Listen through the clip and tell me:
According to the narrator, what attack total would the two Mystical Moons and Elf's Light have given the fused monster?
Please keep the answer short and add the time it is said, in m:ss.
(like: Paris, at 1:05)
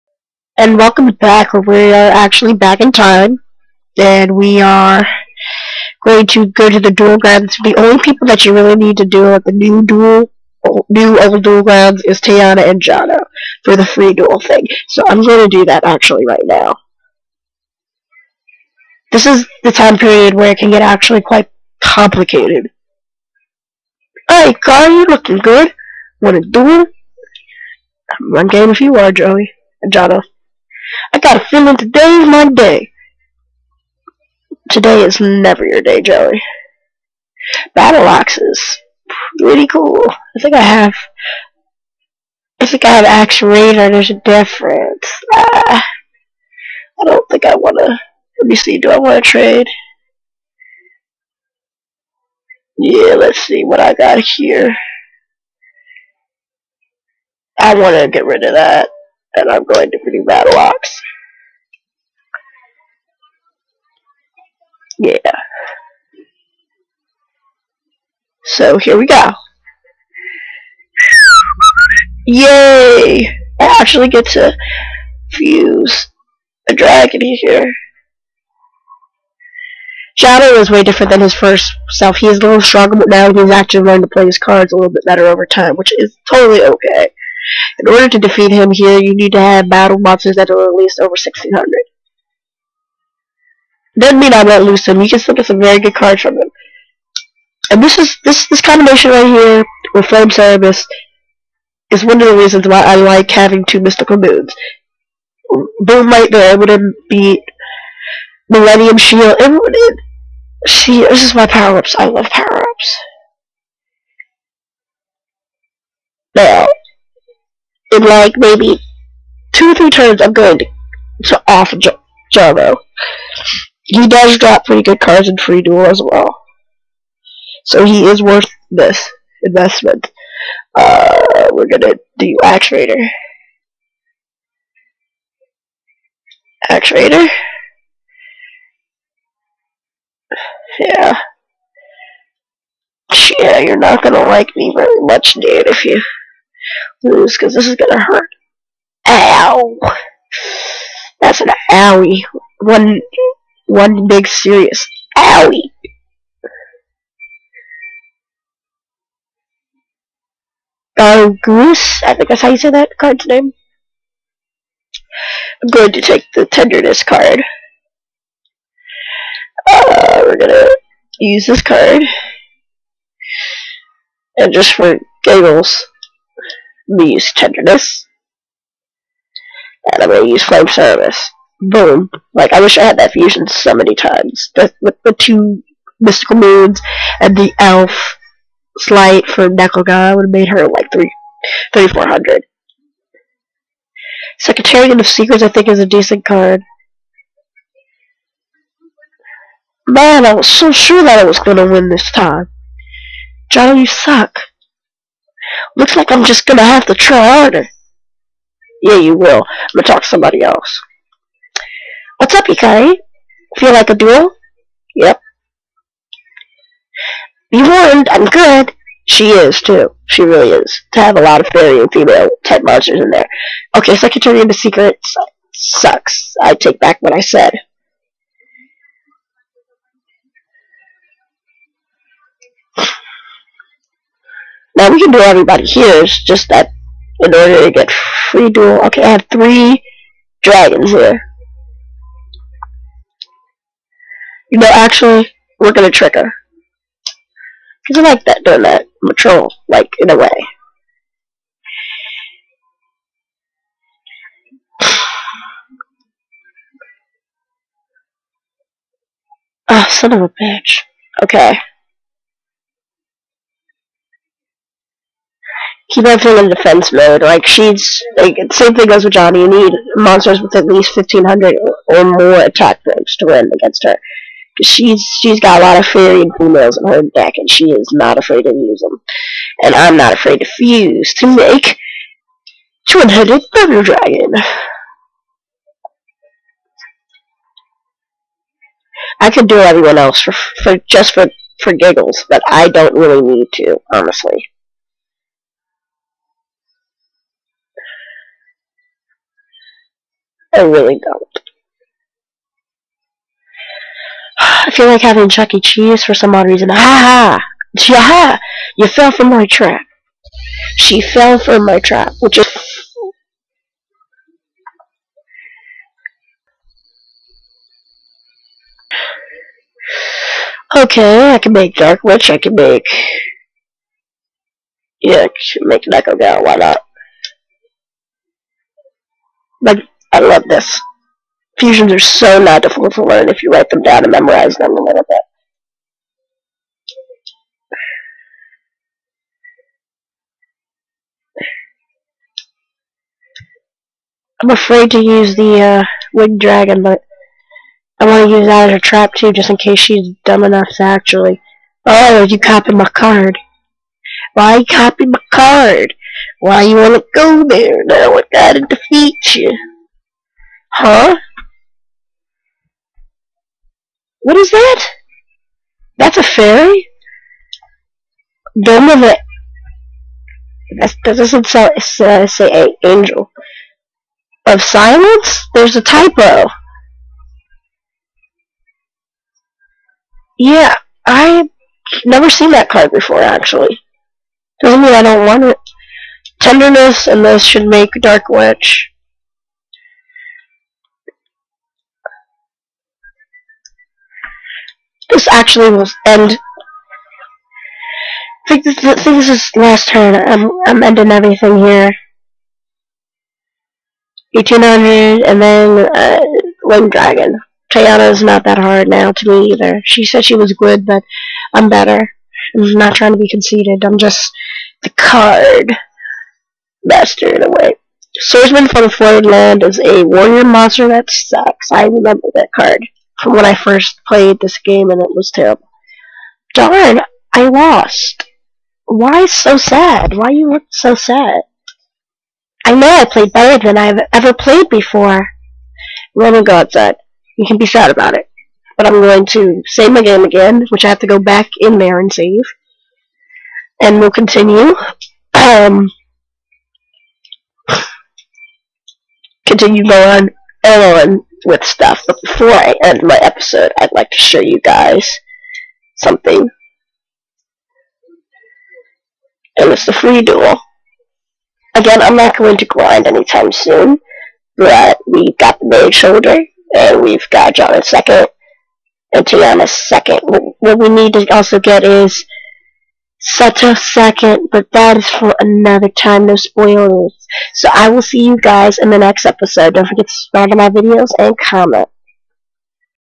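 3400, at 3:10.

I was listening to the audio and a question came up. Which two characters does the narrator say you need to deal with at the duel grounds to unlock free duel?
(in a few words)
Teana and Jono.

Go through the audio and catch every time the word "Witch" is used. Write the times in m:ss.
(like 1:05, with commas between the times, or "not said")
5:22, 6:28.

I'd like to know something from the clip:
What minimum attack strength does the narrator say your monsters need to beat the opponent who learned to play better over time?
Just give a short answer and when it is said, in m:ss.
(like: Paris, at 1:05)
1600, at 1:31.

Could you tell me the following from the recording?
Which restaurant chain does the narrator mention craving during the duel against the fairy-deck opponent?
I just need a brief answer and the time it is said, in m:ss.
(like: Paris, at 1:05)
Chuck E. Cheese, at 5:05.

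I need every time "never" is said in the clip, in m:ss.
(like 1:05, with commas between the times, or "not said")
0:35, 6:22.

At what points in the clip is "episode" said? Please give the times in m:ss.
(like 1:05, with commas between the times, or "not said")
7:33, 7:59.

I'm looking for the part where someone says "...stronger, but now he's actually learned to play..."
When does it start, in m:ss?
1:22.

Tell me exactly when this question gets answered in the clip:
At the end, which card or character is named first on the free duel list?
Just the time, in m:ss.
7:45.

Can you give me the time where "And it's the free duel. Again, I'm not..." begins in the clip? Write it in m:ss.
7:39.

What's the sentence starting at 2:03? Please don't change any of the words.
He does drop pretty good cards in free duel as well.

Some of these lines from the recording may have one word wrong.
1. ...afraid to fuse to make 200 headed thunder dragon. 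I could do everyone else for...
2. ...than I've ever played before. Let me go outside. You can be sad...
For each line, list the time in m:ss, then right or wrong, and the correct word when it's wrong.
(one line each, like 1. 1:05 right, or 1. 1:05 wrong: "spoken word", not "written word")
1. 4:40 right
2. 7:13 right.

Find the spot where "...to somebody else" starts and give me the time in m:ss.
3:30.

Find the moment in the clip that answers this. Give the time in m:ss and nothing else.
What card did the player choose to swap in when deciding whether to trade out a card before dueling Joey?
1:00.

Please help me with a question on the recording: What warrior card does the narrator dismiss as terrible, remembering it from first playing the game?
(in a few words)
Swordsman from a Foreign Land.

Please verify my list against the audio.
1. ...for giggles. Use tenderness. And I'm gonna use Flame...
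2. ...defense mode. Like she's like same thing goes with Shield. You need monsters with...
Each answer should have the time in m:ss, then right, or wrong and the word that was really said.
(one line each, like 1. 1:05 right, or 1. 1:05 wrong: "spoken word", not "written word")
1. 2:54 right
2. 4:26 wrong: "Johnny", not "Shield".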